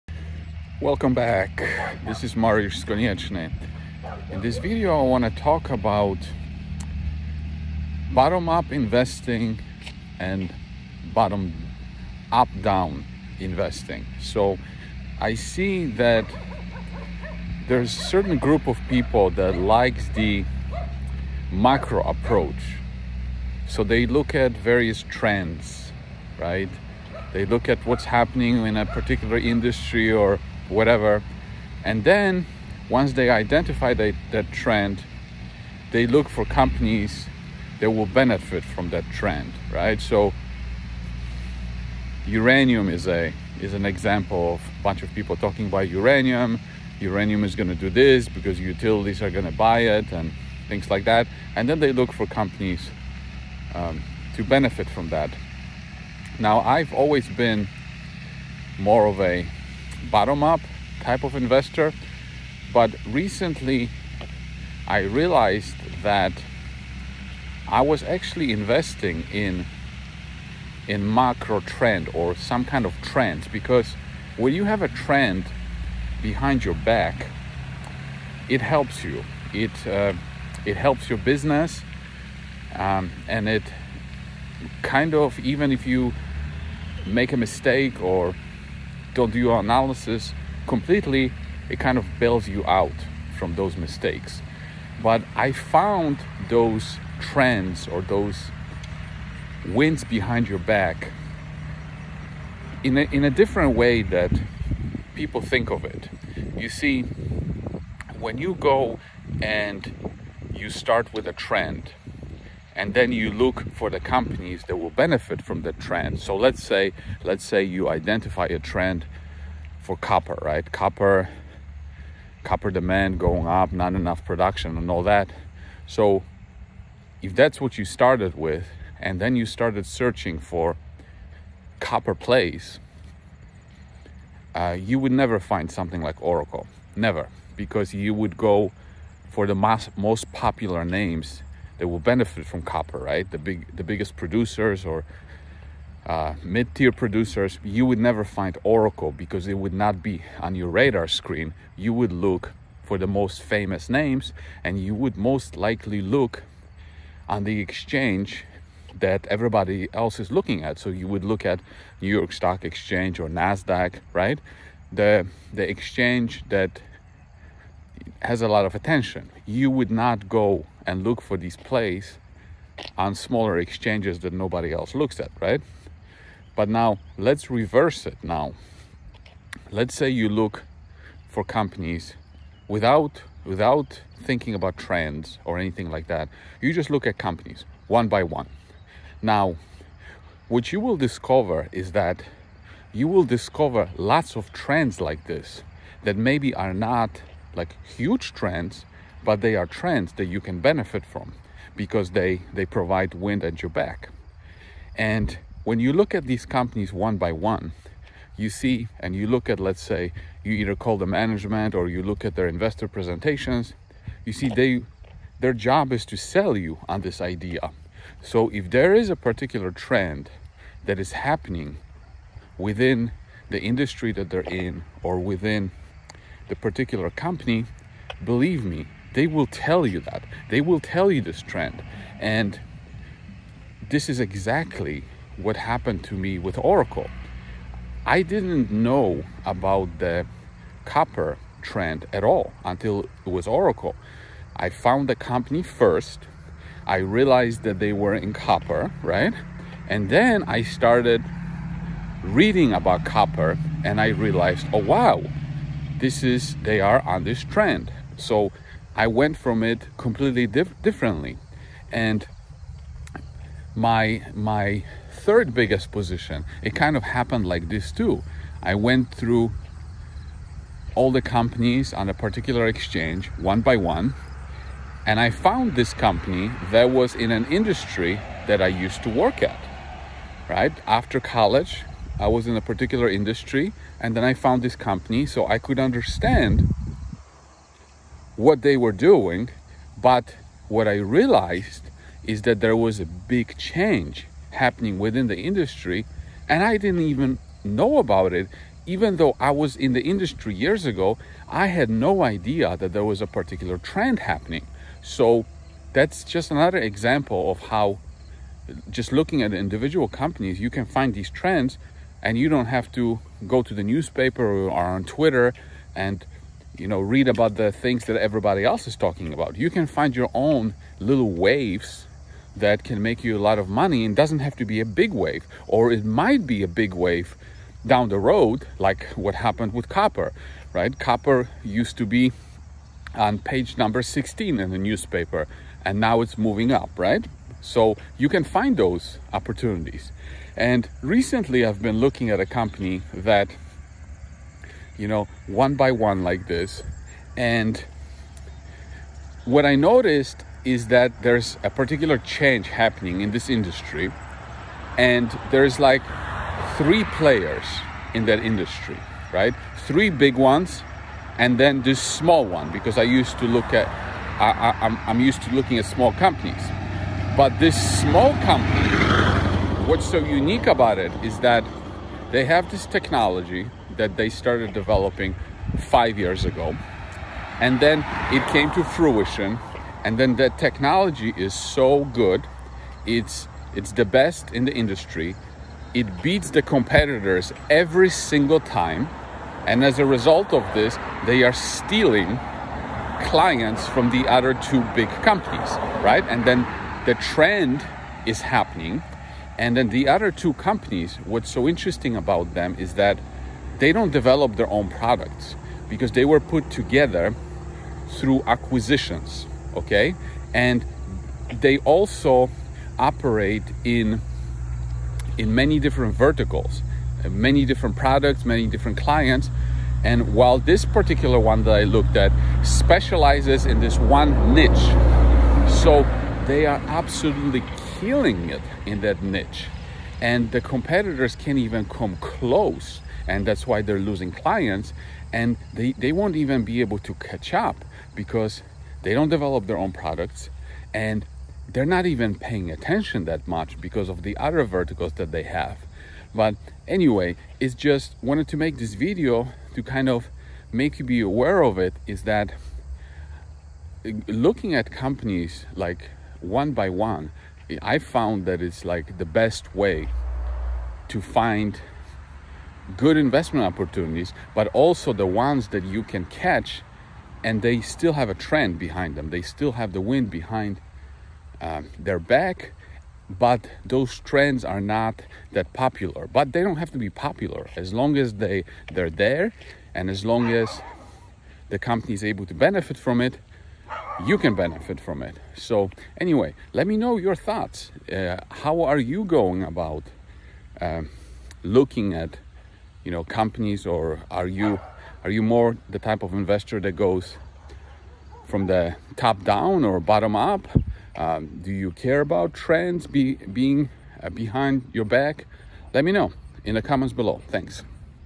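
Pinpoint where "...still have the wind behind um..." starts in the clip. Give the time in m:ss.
7:49.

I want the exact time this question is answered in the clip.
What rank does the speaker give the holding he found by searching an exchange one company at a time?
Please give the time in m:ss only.
4:25.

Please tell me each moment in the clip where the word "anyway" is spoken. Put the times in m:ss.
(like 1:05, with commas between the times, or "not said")
7:26, 8:06.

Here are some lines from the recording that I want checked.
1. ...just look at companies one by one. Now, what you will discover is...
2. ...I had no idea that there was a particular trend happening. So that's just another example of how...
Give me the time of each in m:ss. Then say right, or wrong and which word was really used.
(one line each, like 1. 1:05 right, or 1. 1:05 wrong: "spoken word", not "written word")
1. 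3:06 right
2. 5:01 right.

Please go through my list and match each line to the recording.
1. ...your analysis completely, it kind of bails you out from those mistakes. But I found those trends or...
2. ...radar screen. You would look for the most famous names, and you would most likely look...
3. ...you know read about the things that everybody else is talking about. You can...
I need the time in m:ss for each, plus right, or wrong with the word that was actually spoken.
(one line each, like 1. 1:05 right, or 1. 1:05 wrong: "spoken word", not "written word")
1. 1:29 right
2. 2:30 right
3. 5:16 right.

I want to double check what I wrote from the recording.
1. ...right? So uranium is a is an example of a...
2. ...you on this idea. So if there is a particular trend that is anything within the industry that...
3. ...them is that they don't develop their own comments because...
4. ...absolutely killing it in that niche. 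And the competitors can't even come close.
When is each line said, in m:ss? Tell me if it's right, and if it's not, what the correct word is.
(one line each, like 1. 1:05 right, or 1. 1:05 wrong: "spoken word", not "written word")
1. 0:39 right
2. 3:36 wrong: "happening", not "anything"
3. 6:42 wrong: "products", not "comments"
4. 7:06 right.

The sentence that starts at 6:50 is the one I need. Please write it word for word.
And they also operate in in many different verticals, many different products, many different clients.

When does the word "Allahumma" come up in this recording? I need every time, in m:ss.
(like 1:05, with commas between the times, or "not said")
not said.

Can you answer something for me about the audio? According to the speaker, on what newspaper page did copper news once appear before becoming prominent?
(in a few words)
16.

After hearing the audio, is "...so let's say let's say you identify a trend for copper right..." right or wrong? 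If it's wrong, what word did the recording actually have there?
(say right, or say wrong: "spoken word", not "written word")
right.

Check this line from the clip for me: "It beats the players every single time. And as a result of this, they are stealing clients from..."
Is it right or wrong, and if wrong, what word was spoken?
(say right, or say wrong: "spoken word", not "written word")
wrong: "competitors", not "players".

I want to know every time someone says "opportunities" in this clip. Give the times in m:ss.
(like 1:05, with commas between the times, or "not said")
5:39, 7:43.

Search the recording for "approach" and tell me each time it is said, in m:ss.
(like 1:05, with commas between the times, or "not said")
0:22.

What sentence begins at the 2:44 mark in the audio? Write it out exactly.
The the exchange that has a lot of attention.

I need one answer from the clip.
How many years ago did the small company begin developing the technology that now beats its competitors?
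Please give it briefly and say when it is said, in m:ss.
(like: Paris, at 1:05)
5, at 6:15.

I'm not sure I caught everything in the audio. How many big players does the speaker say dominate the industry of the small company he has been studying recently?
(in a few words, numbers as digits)
3.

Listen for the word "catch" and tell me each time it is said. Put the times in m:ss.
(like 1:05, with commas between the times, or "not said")
7:17, 7:46.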